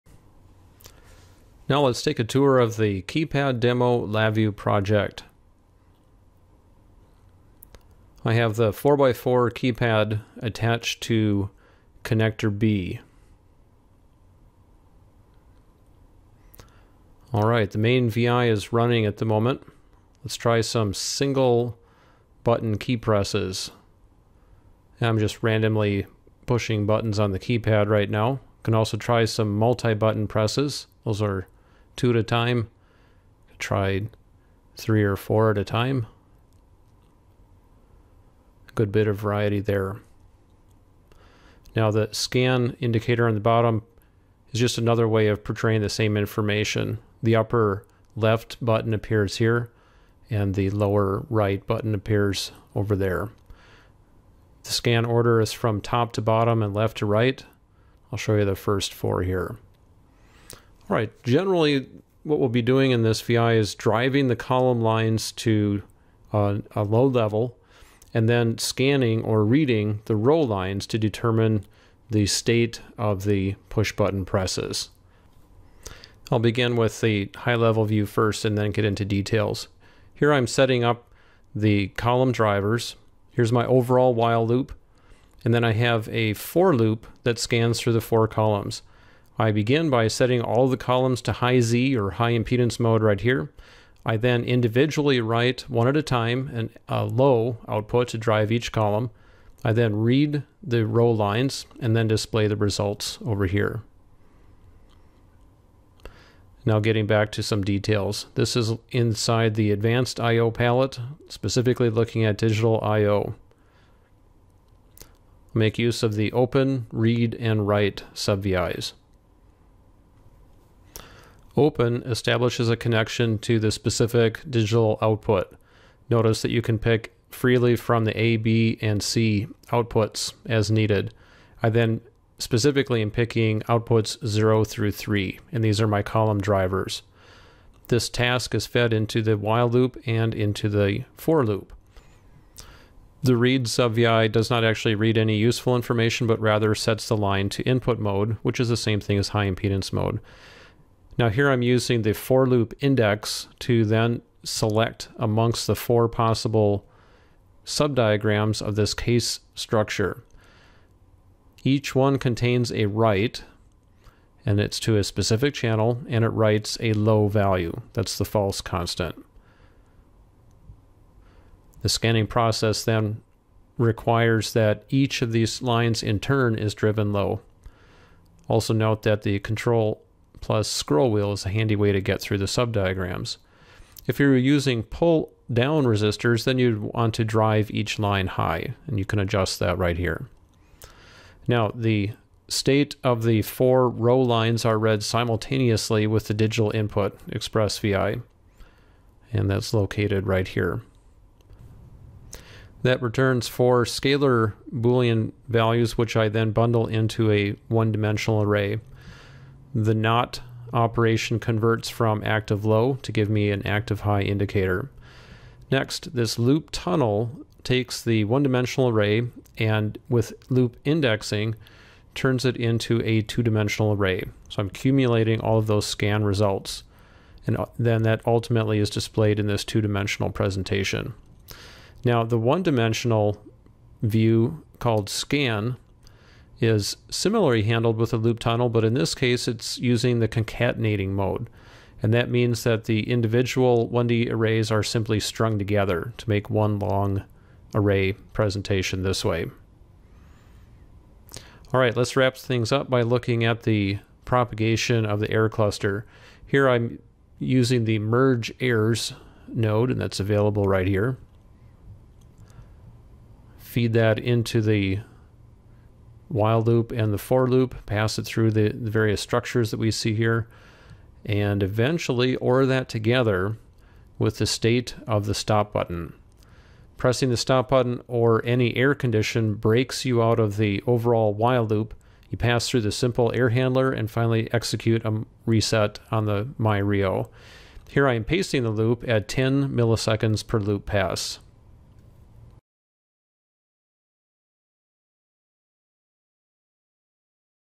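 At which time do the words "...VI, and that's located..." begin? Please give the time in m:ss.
3:17.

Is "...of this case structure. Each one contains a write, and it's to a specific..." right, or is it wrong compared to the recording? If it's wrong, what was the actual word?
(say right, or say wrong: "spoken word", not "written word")
right.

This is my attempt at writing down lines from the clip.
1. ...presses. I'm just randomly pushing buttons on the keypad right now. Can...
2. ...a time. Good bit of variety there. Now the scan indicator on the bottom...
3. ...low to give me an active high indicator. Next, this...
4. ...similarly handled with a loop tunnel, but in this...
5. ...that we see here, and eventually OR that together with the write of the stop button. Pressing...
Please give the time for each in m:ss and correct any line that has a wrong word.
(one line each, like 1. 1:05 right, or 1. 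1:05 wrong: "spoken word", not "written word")
1. 0:22 right
2. 0:35 right
3. 3:32 right
4. 3:57 right
5. 4:29 wrong: "state", not "write".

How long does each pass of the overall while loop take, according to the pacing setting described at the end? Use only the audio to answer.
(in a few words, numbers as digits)
10 milliseconds.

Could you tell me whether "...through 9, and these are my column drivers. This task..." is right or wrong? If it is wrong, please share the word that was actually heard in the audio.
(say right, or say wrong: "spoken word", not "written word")
wrong: "3", not "9".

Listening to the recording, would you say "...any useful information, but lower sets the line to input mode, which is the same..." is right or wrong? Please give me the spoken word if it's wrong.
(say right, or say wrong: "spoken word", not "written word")
wrong: "rather", not "lower".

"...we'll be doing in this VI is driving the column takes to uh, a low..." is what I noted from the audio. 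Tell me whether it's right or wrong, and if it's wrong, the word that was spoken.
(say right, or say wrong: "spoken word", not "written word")
wrong: "lines", not "takes".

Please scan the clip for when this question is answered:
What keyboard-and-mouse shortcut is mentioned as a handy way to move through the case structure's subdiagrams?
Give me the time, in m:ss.
2:59.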